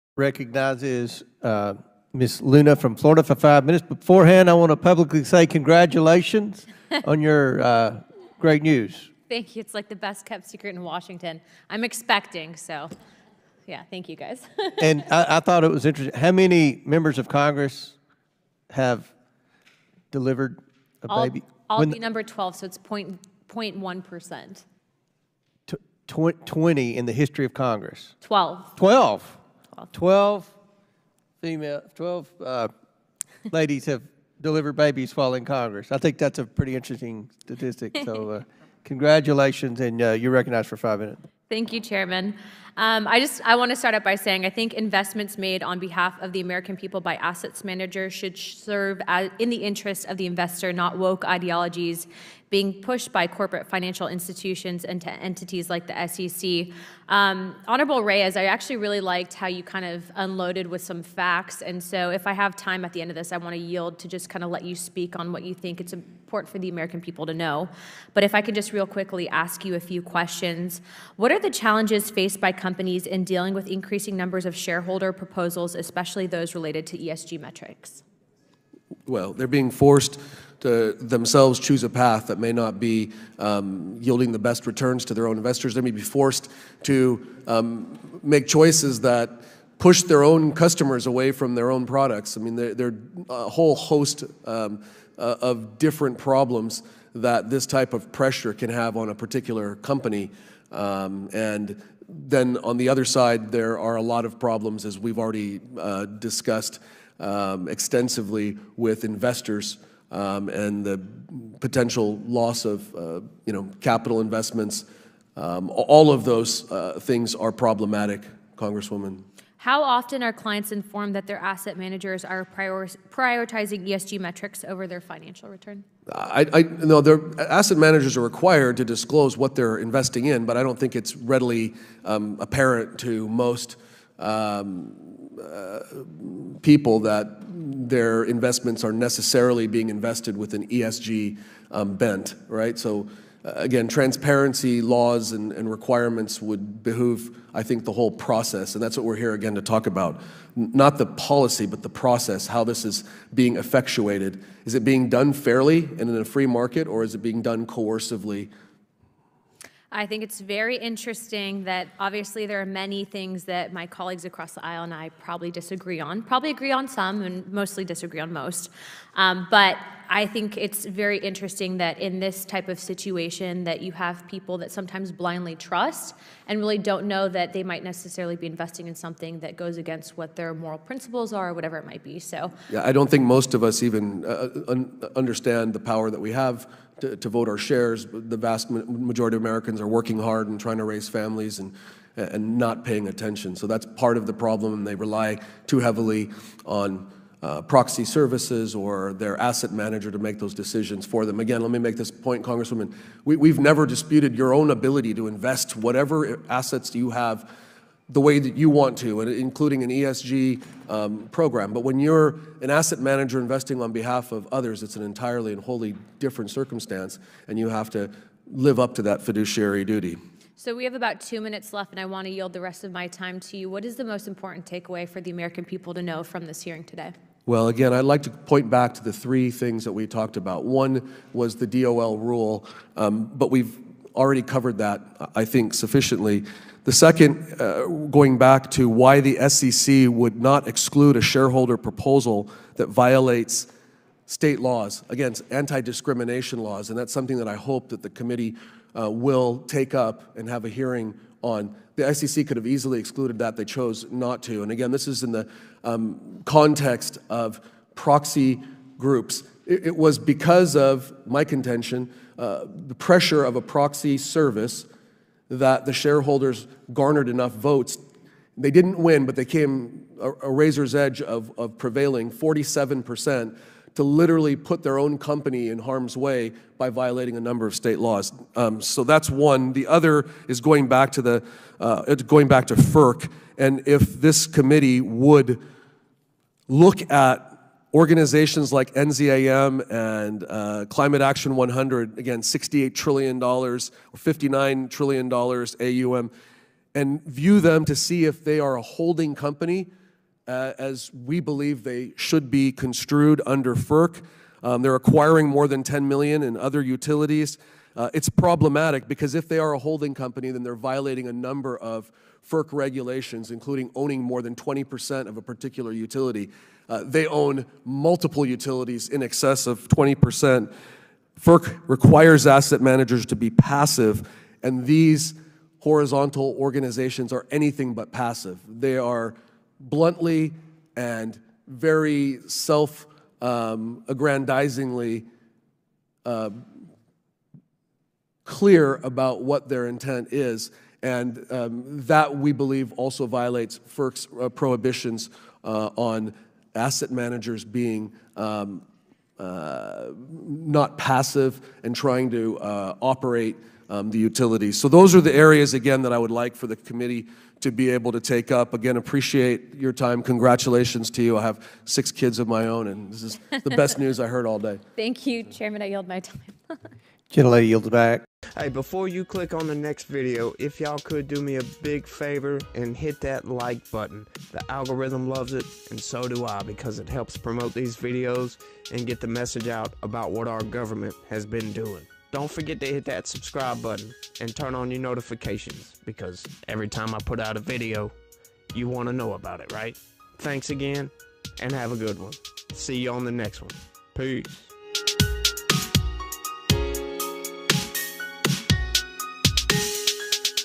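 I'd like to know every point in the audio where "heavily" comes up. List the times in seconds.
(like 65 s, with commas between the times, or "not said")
195 s.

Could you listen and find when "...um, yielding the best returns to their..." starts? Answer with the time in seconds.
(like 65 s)
83 s.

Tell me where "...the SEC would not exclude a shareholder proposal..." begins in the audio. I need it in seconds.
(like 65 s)
239 s.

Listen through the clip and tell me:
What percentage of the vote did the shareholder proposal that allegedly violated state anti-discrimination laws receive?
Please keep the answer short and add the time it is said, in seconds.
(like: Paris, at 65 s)
47%, at 272 s.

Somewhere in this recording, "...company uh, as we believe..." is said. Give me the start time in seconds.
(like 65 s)
299 s.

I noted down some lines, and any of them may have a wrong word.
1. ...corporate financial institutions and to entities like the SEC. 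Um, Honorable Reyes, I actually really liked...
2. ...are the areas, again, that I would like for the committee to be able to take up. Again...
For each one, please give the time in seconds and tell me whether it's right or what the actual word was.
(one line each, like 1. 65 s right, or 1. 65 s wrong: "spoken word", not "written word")
1. 53 s right
2. 355 s right.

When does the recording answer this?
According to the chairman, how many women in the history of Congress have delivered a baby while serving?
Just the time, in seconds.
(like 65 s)
31 s.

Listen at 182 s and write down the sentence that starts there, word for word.
So yeah, I don't think most of us even uh, un understand the power that we have to, to vote our shares.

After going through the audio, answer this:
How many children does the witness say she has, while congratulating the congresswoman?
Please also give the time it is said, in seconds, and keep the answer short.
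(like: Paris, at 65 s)
6, at 361 s.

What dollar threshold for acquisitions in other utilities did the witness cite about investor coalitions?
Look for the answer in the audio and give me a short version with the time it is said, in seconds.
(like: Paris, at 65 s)
10 million, at 305 s.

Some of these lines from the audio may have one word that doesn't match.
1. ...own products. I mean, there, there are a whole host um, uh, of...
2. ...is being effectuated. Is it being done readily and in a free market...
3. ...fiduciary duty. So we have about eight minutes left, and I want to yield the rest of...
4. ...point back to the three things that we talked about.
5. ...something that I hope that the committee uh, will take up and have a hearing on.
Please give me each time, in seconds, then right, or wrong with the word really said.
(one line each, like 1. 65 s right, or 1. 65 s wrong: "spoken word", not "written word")
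1. 91 s right
2. 152 s wrong: "fairly", not "readily"
3. 219 s wrong: "two", not "eight"
4. 228 s right
5. 247 s right.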